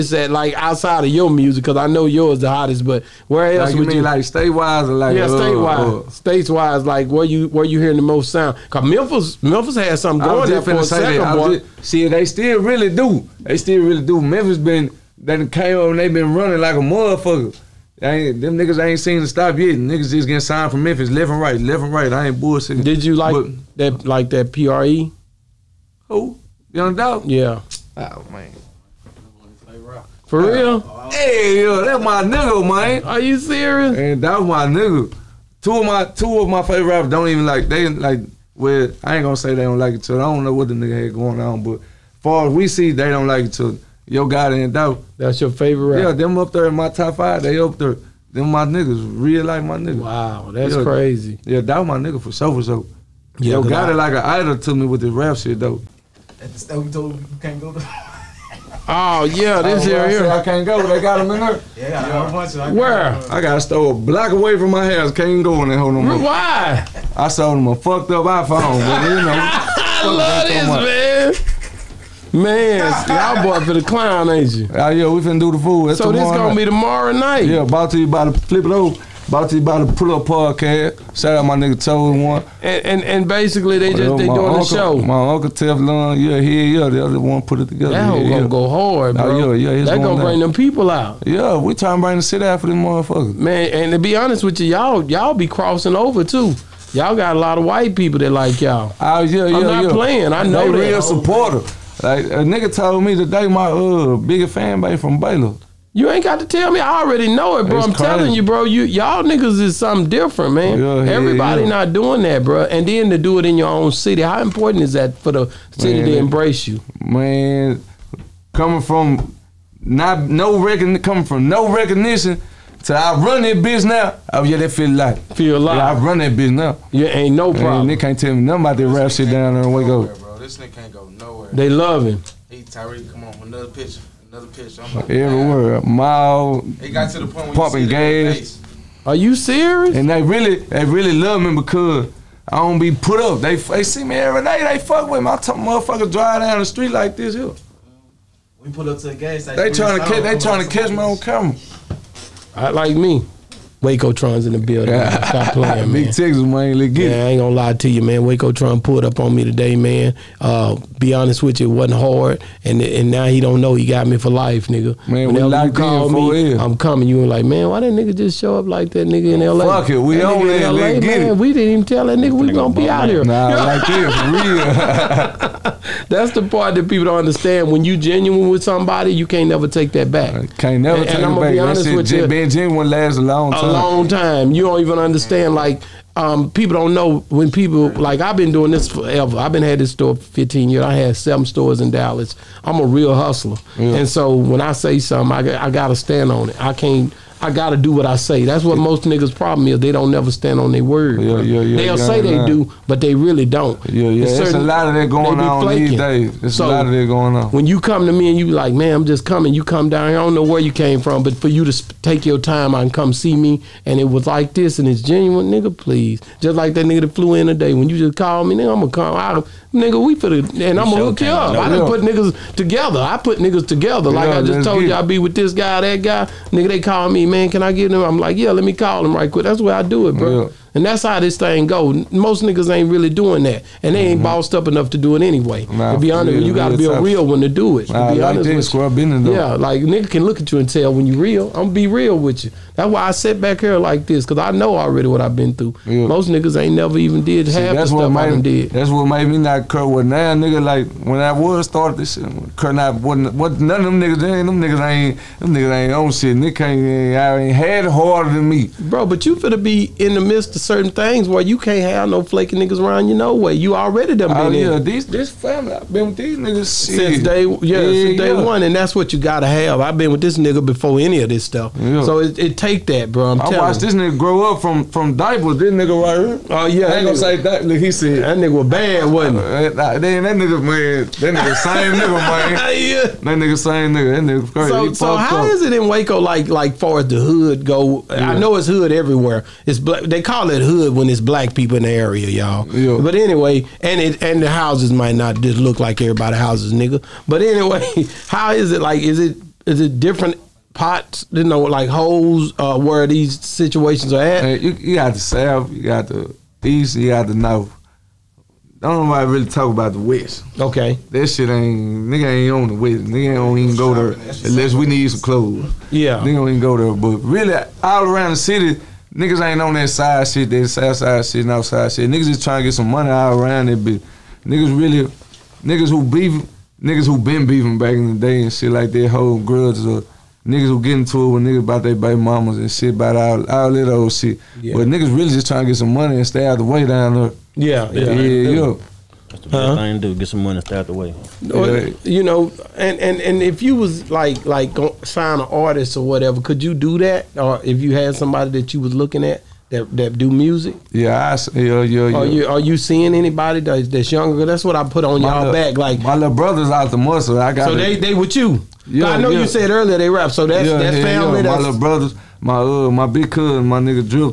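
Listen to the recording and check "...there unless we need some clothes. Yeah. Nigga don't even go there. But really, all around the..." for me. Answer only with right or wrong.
right.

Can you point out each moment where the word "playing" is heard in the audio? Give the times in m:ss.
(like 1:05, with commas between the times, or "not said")
1:39, 2:35.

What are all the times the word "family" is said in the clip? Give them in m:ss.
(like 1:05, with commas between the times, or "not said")
4:25, 6:00.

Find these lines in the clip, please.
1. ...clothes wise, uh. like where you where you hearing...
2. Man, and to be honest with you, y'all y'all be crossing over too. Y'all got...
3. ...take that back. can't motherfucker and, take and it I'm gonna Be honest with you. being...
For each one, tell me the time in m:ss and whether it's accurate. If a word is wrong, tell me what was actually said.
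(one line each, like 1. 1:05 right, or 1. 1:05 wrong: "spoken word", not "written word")
1. 0:06 wrong: "states", not "clothes"
2. 1:33 right
3. 2:59 wrong: "never", not "motherfucker".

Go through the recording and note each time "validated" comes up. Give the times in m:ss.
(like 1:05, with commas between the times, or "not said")
not said.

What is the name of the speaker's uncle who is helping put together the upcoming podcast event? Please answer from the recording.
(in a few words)
Teflon.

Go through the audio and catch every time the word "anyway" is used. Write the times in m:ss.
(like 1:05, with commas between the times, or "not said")
3:55, 4:53, 4:57.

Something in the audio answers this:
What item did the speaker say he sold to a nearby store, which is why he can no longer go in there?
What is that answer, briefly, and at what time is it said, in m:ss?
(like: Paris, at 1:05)
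iPhone, at 1:08.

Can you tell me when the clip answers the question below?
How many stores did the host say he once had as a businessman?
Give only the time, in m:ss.
3:11.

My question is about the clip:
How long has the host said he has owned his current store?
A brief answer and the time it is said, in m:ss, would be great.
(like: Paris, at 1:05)
15 years, at 3:10.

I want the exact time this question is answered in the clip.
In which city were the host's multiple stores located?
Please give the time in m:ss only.
3:11.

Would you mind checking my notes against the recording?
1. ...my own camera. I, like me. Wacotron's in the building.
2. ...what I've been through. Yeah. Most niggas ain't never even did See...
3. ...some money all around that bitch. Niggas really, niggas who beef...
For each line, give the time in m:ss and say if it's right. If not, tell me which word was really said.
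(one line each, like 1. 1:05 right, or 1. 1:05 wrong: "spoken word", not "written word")
1. 2:30 right
2. 4:05 right
3. 5:22 right.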